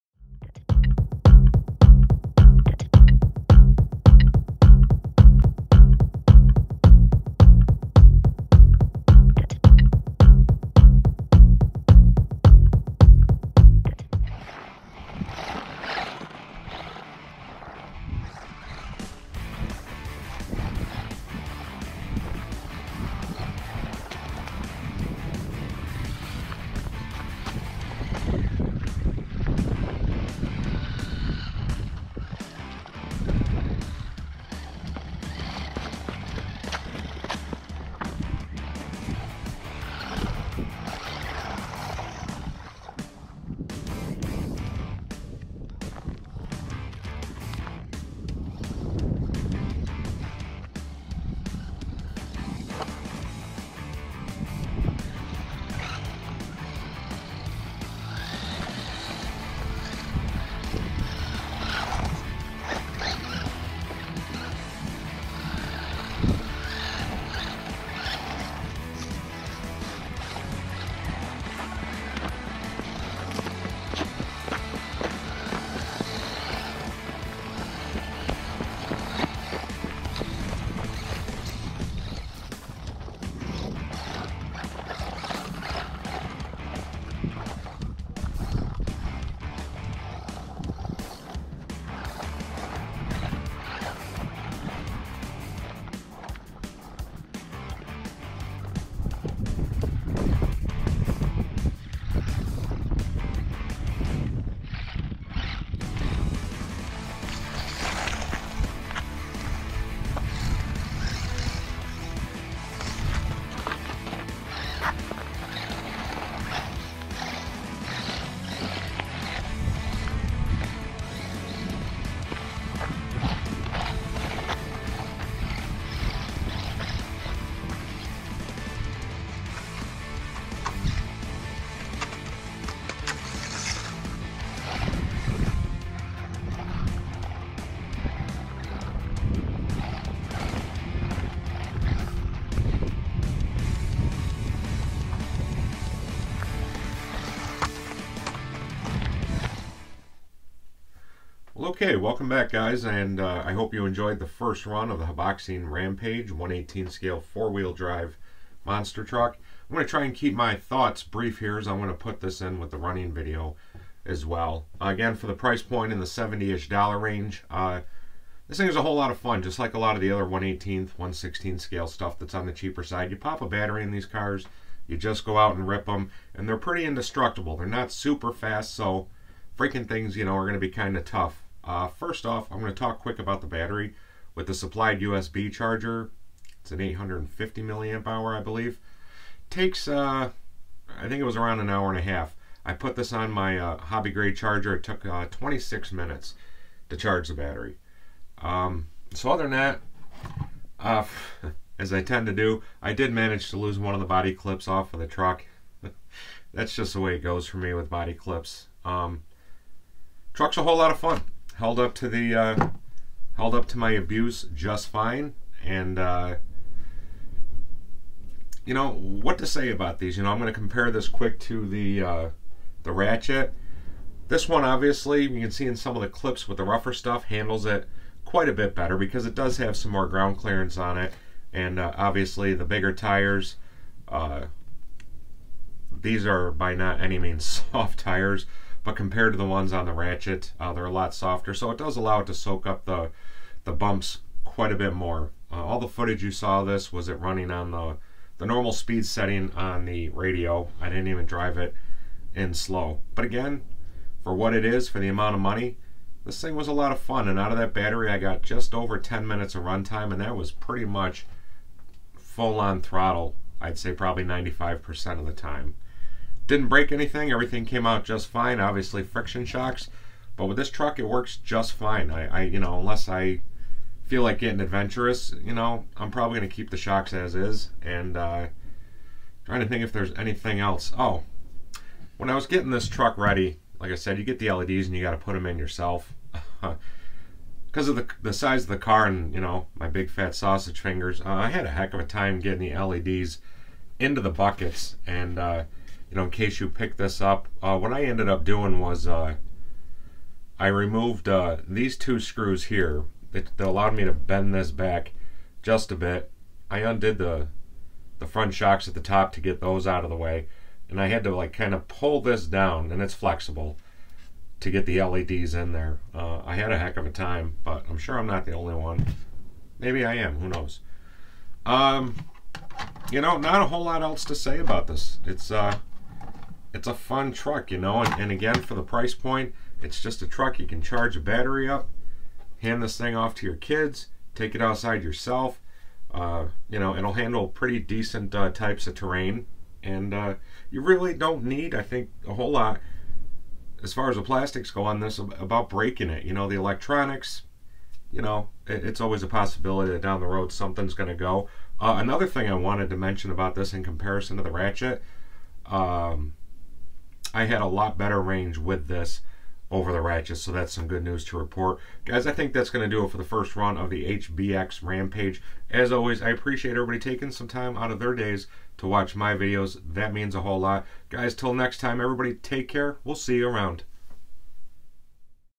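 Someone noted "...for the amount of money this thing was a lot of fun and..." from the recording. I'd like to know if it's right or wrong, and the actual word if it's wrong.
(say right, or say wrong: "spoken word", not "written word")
right.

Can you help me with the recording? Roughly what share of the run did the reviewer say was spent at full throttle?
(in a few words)
95%.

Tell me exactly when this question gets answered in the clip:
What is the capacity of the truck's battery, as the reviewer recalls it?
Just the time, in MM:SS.
03:06.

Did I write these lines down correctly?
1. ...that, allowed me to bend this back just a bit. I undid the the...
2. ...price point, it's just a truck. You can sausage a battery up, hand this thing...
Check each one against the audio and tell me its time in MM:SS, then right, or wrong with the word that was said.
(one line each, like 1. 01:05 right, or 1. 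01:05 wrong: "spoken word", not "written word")
1. 05:03 right
2. 05:28 wrong: "charge", not "sausage".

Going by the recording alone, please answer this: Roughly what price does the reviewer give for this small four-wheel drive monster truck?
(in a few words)
70 dollars.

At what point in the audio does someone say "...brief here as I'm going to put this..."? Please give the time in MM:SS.
02:41.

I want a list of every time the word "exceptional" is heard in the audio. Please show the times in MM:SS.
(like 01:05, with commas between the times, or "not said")
not said.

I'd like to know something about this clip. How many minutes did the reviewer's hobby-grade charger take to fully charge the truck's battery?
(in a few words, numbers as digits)
26 minutes.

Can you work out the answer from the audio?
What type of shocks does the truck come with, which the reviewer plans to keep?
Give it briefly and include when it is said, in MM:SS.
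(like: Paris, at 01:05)
friction shocks, at 04:29.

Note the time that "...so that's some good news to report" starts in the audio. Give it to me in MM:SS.
06:00.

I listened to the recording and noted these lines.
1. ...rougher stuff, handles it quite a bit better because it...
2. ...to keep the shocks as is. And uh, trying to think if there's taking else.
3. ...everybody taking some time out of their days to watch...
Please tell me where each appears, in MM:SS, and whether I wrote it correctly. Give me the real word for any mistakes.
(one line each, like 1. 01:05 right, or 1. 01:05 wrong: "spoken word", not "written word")
1. 03:46 right
2. 04:36 wrong: "anything", not "taking"
3. 06:06 right.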